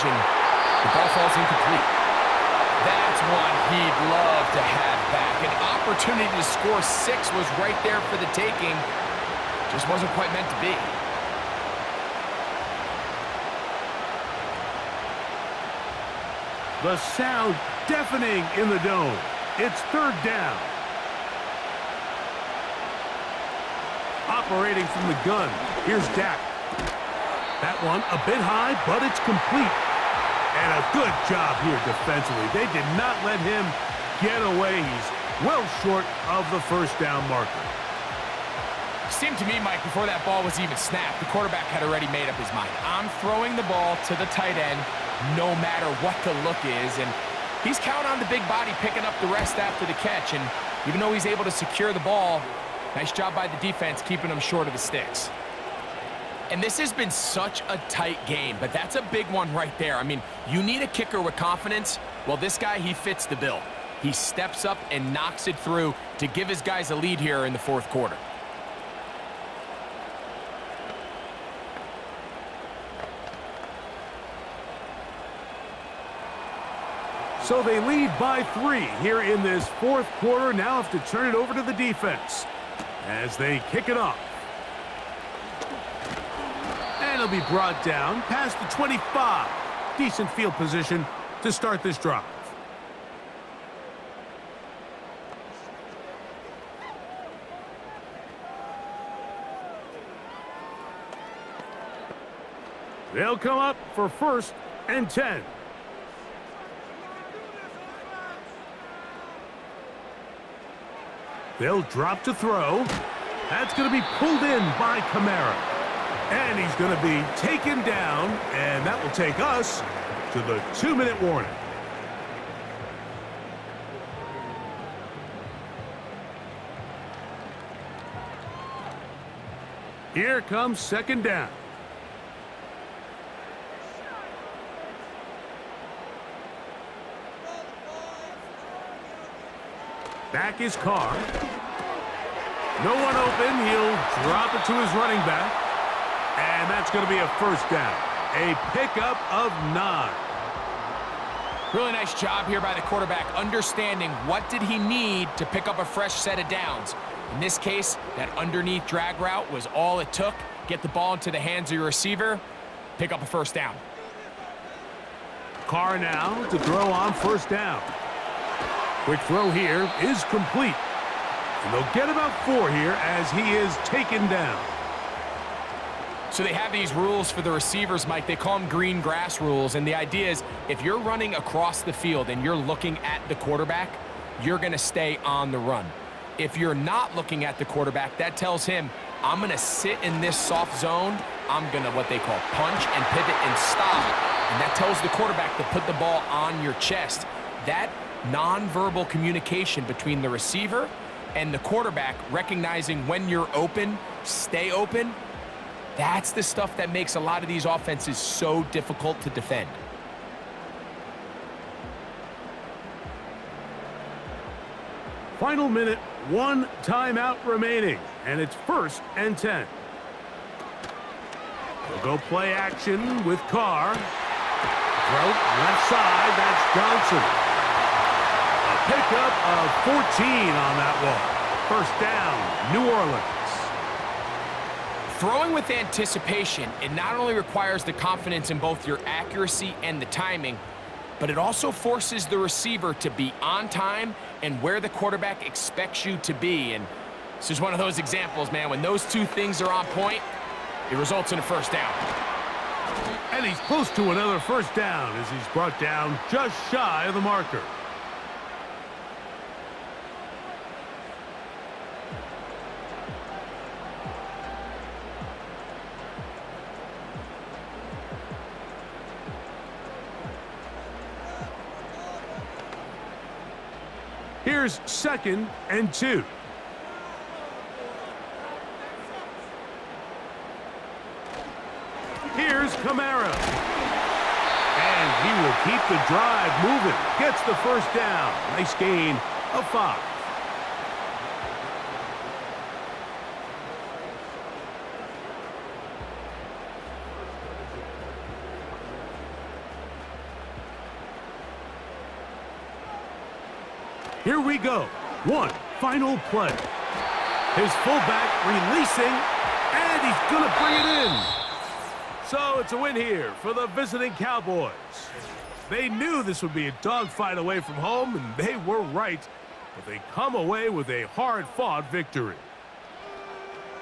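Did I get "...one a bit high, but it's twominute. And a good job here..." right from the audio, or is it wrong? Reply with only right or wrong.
wrong.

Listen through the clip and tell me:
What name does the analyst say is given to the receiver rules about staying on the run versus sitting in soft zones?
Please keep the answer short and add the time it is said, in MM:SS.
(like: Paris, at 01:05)
green grass rules, at 02:58.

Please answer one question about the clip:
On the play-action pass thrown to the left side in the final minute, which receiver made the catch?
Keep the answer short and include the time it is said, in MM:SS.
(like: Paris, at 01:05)
Johnson, at 03:46.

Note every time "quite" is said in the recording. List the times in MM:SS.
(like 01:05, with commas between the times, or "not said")
00:10.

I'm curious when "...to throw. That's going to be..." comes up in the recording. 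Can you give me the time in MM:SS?
01:52.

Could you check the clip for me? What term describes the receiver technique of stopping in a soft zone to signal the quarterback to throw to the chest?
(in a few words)
punch and pivot.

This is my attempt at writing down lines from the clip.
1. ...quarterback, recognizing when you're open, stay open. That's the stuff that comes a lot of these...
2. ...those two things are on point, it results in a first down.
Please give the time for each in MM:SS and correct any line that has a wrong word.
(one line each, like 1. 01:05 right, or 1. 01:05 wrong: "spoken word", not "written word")
1. 03:21 wrong: "makes", not "comes"
2. 04:08 right.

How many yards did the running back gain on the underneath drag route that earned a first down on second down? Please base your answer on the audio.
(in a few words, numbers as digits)
9.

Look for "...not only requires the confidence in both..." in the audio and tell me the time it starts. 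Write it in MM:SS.
03:56.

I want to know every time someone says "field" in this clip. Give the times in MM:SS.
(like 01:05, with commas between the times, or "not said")
01:30, 03:01.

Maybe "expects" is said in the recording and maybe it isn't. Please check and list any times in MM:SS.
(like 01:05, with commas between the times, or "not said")
04:05.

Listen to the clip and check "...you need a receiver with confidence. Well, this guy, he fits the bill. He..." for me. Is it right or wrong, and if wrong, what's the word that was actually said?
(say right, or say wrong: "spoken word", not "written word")
wrong: "kicker", not "receiver".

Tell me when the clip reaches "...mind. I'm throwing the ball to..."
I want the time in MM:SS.
00:42.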